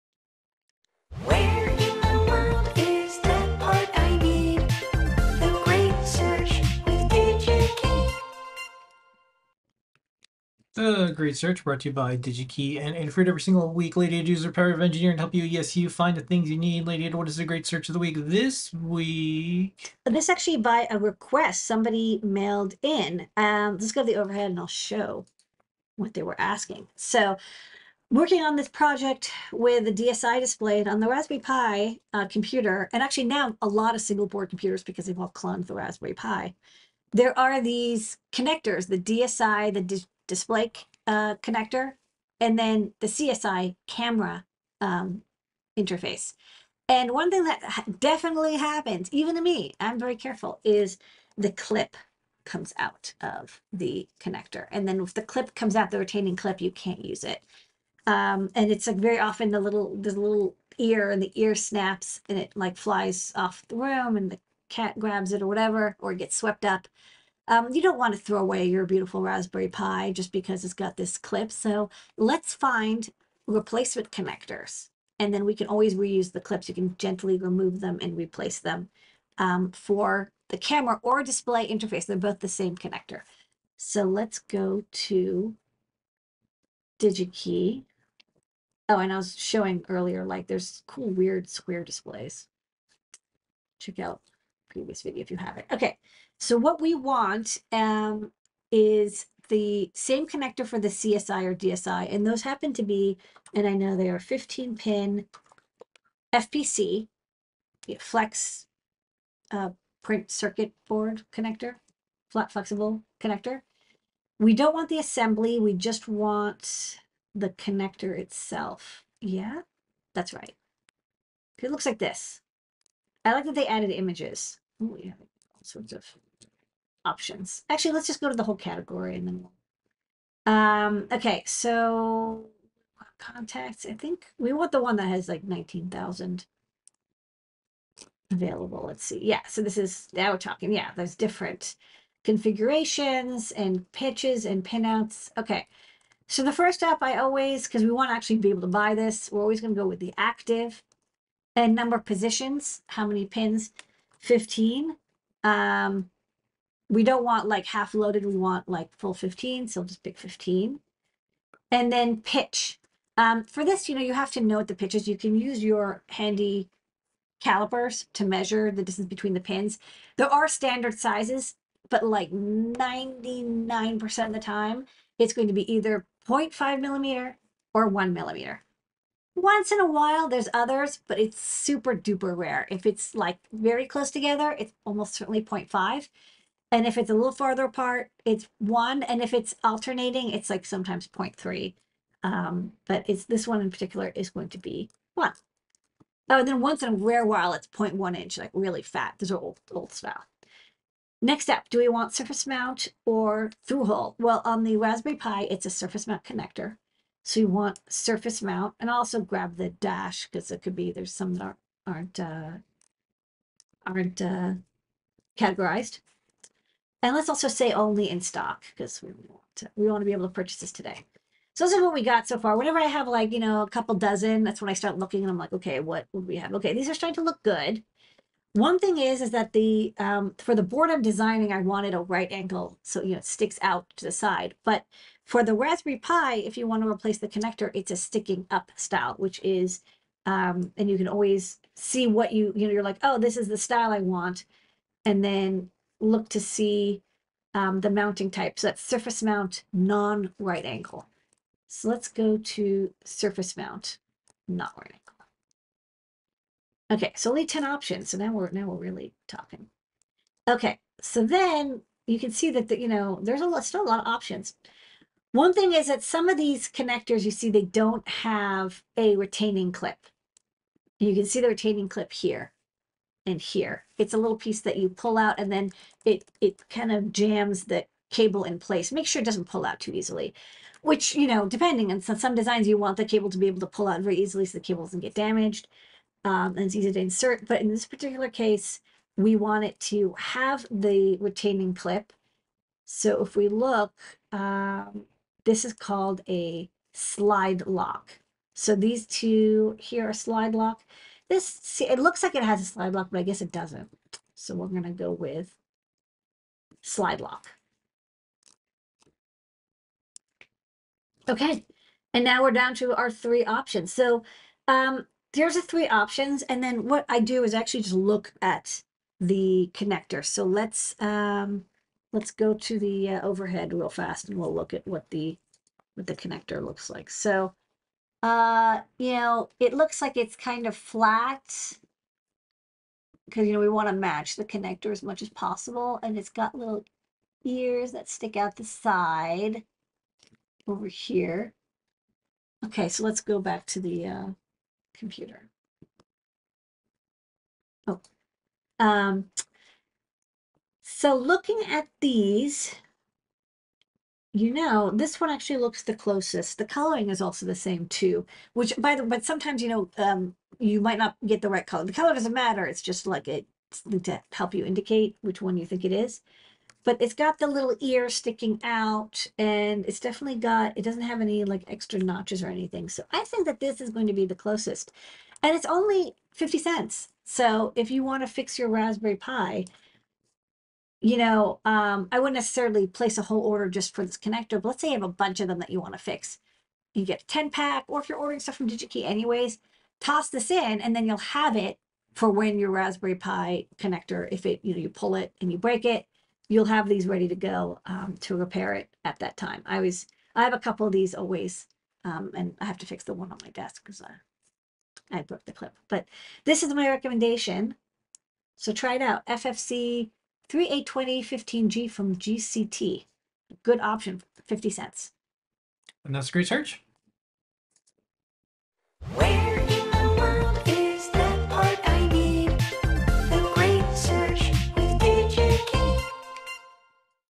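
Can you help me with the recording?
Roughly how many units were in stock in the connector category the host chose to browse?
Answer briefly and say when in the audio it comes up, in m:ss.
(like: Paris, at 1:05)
19,000, at 2:15.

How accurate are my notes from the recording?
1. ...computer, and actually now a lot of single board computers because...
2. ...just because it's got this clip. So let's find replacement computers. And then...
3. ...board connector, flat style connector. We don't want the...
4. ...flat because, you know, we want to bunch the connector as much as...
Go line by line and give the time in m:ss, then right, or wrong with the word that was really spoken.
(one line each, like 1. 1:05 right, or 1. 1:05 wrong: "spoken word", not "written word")
1. 0:32 right
2. 1:10 wrong: "connectors", not "computers"
3. 1:50 wrong: "flexible", not "style"
4. 5:30 wrong: "match", not "bunch".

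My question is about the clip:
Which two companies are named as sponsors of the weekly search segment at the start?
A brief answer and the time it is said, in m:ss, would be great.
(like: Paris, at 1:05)
DigiKey and Infrared, at 0:12.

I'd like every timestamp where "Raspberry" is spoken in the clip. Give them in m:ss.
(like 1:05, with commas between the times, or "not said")
0:31, 0:35, 1:09, 3:24, 3:55, 6:18, 6:32.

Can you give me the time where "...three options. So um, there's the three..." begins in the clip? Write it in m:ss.
5:13.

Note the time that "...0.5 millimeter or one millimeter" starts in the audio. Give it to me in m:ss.
2:56.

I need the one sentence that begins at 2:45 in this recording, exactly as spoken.
You can use your handy calipers to measure the distance between the pins.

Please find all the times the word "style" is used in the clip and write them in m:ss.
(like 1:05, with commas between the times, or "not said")
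3:19, 3:58, 4:03.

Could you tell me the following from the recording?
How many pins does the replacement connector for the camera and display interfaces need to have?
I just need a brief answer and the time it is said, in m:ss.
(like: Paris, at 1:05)
15, at 1:44.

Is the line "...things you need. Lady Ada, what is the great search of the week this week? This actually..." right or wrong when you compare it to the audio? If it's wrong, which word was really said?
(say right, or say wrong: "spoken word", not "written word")
right.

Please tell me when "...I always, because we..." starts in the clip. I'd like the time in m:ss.
2:27.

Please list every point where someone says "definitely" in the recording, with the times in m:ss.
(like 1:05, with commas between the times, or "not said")
0:47, 6:09.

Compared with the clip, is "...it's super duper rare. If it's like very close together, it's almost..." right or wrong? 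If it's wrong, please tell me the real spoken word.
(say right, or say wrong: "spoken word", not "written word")
right.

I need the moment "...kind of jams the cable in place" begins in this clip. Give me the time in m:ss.
4:36.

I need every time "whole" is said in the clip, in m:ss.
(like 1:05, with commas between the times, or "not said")
2:08, 6:23.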